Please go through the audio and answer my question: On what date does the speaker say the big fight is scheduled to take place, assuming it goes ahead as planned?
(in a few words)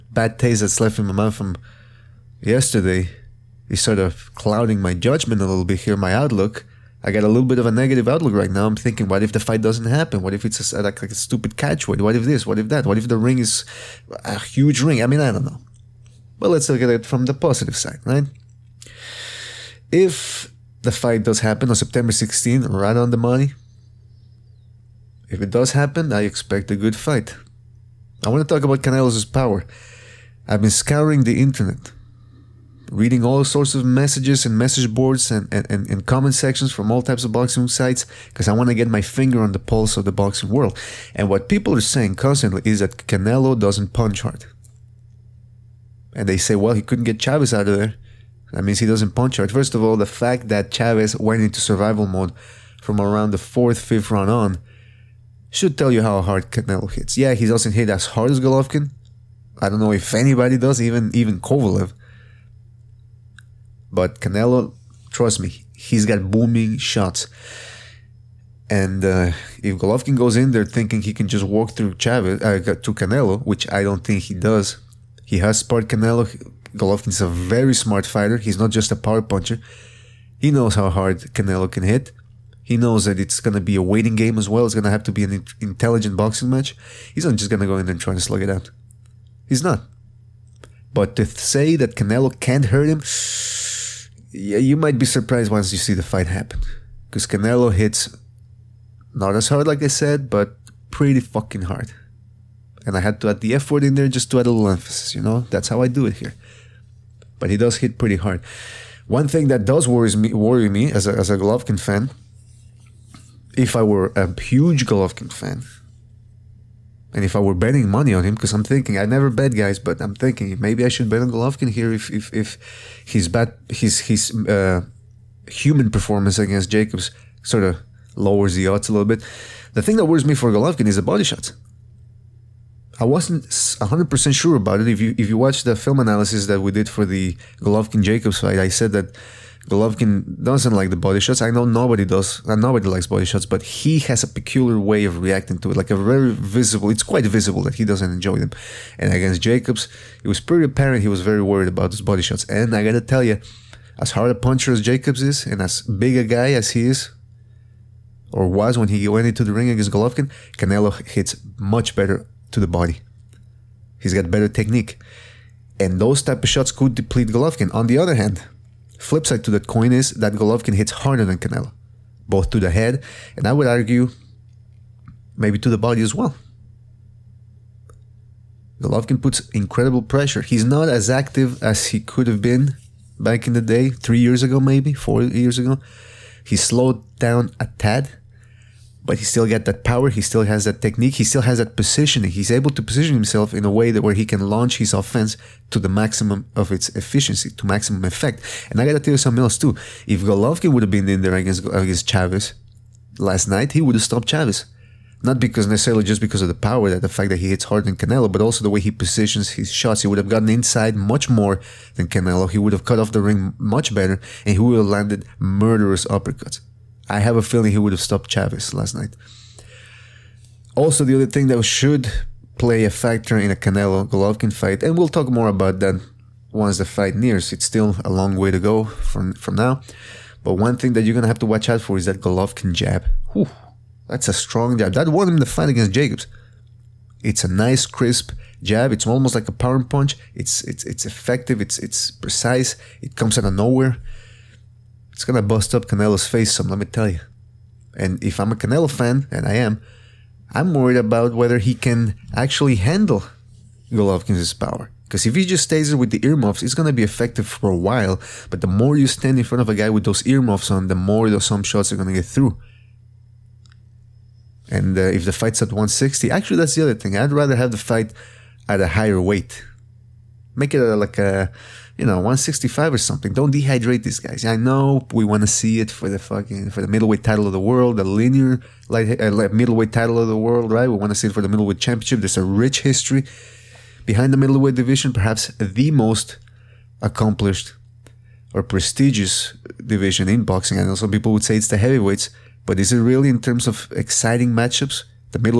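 September 16.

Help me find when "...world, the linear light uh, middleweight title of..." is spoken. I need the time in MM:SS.
04:37.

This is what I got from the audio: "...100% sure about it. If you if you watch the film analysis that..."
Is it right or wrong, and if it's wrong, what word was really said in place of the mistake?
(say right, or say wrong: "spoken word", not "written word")
right.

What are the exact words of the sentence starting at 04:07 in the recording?
And if I'm a Canelo fan, and I am, I'm worried about whether he can actually handle Golovkin's power.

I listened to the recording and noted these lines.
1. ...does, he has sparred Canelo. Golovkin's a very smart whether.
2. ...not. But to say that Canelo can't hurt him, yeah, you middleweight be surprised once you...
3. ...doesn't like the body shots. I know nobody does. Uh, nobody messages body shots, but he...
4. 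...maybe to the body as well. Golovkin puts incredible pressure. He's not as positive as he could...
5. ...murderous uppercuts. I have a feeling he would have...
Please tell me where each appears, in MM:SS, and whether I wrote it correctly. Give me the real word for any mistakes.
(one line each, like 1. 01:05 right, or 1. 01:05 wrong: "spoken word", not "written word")
1. 01:14 wrong: "fighter", not "whether"
2. 01:29 wrong: "might", not "middleweight"
3. 02:20 wrong: "likes", not "messages"
4. 02:55 wrong: "active", not "positive"
5. 03:35 right.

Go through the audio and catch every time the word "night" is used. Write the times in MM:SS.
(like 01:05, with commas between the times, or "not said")
03:23, 03:38.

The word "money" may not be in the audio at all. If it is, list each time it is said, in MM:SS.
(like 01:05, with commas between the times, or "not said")
00:23, 01:57.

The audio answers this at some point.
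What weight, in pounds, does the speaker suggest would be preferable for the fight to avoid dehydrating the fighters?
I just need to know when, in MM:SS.
04:32.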